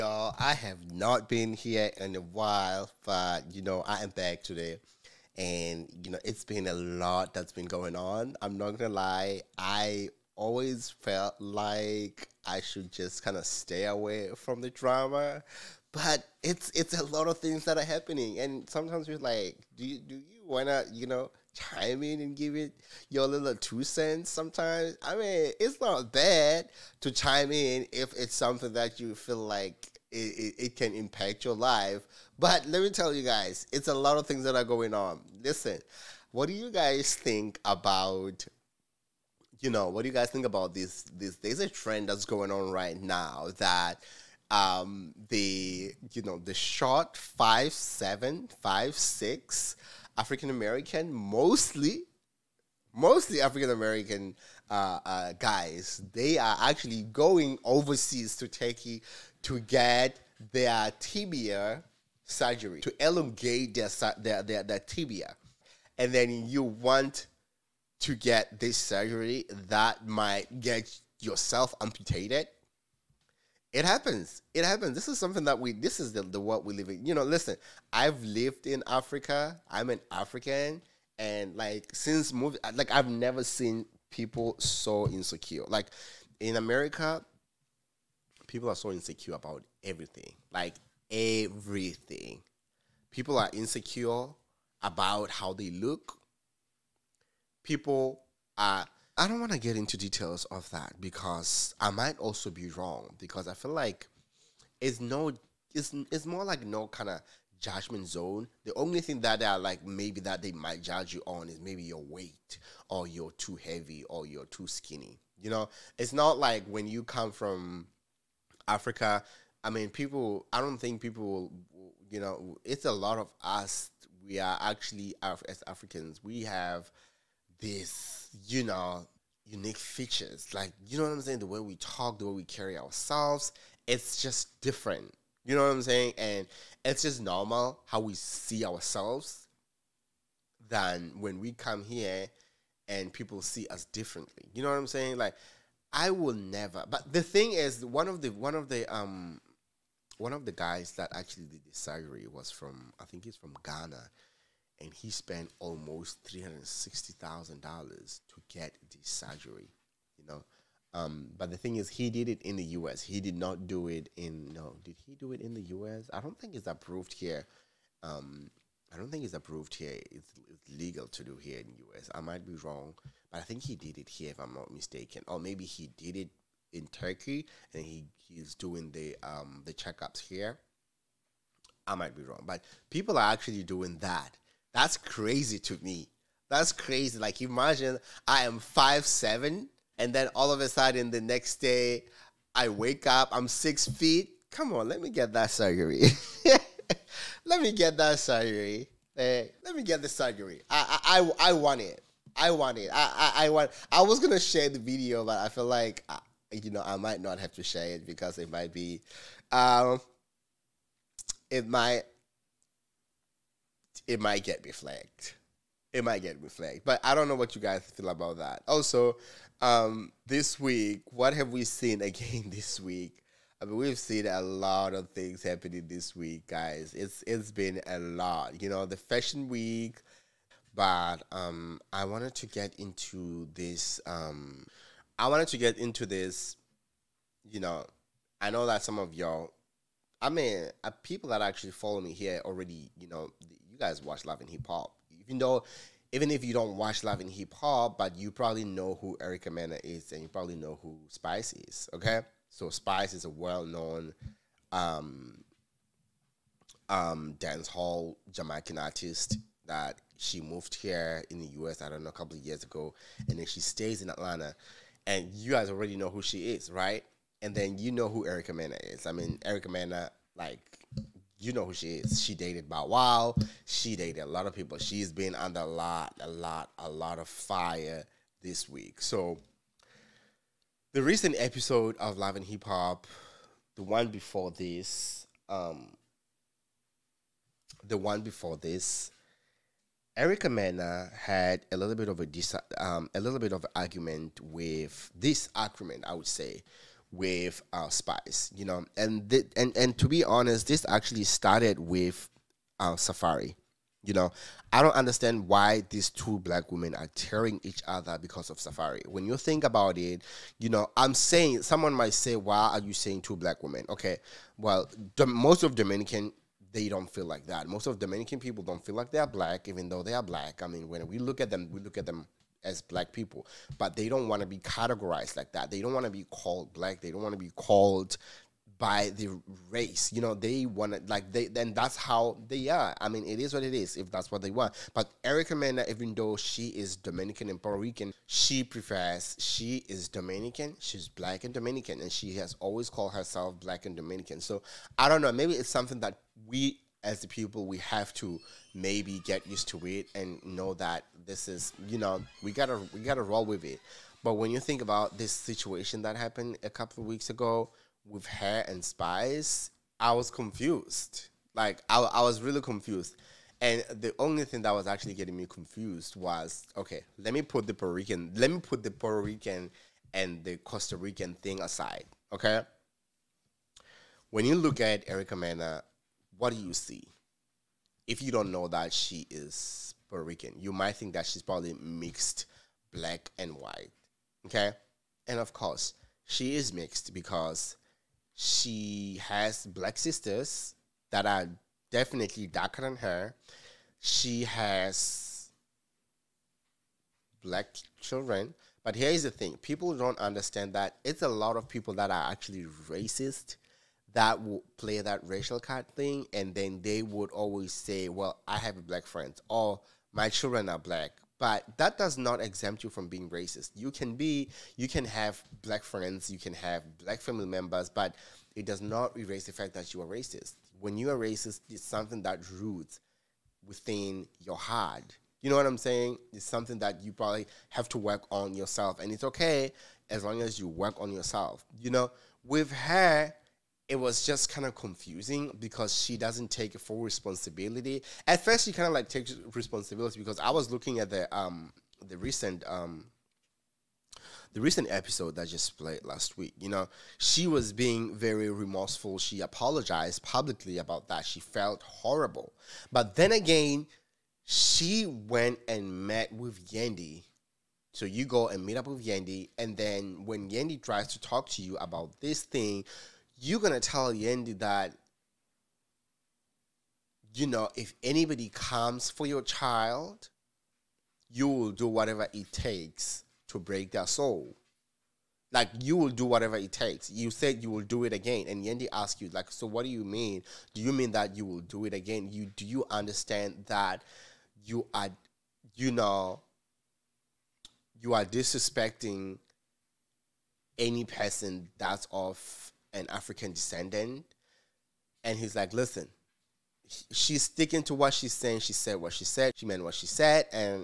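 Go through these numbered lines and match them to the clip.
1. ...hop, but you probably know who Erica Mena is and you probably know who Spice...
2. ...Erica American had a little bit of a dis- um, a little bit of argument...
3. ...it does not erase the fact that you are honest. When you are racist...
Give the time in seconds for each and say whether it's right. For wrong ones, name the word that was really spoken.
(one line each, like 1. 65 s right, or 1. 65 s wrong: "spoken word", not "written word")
1. 247 s right
2. 290 s wrong: "Mena", not "American"
3. 418 s wrong: "racist", not "honest".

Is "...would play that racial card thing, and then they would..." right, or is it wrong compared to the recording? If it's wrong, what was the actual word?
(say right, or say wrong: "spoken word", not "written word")
right.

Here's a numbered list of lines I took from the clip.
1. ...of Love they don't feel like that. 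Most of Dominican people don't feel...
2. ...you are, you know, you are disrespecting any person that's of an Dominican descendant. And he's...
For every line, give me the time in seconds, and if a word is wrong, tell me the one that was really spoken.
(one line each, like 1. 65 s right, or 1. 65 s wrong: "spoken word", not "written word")
1. 315 s wrong: "Dominican", not "Love"
2. 484 s wrong: "African", not "Dominican".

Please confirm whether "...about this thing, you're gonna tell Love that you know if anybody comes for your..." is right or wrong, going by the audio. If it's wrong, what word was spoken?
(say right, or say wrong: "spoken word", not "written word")
wrong: "Yandy", not "Love".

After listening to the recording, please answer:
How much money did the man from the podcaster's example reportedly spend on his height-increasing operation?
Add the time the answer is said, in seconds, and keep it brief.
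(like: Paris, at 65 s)
$360,000, at 156 s.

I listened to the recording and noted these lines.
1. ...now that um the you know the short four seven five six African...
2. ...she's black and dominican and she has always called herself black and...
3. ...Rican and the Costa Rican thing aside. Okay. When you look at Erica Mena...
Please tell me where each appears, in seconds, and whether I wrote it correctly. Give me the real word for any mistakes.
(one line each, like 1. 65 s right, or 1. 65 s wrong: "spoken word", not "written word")
1. 43 s wrong: "five", not "four"
2. 340 s right
3. 369 s right.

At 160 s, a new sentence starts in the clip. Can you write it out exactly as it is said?
You know, um, but the thing is, he did it in the U.S.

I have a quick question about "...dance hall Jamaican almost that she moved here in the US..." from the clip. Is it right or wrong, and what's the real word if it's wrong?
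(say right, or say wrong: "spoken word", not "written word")
wrong: "artist", not "almost".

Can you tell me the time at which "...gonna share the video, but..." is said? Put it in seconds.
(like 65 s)
204 s.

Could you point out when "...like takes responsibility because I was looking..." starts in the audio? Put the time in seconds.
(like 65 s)
438 s.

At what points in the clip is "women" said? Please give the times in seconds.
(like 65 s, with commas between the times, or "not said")
306 s, 313 s.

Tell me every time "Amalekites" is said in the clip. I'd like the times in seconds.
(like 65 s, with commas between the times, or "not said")
not said.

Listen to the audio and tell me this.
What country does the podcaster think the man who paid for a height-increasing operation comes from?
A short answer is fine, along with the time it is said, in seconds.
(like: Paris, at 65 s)
Ghana, at 153 s.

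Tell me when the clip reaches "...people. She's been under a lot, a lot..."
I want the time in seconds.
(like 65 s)
274 s.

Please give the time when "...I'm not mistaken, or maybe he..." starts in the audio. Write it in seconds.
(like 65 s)
174 s.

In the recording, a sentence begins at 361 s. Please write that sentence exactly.
Like I, I was really confused.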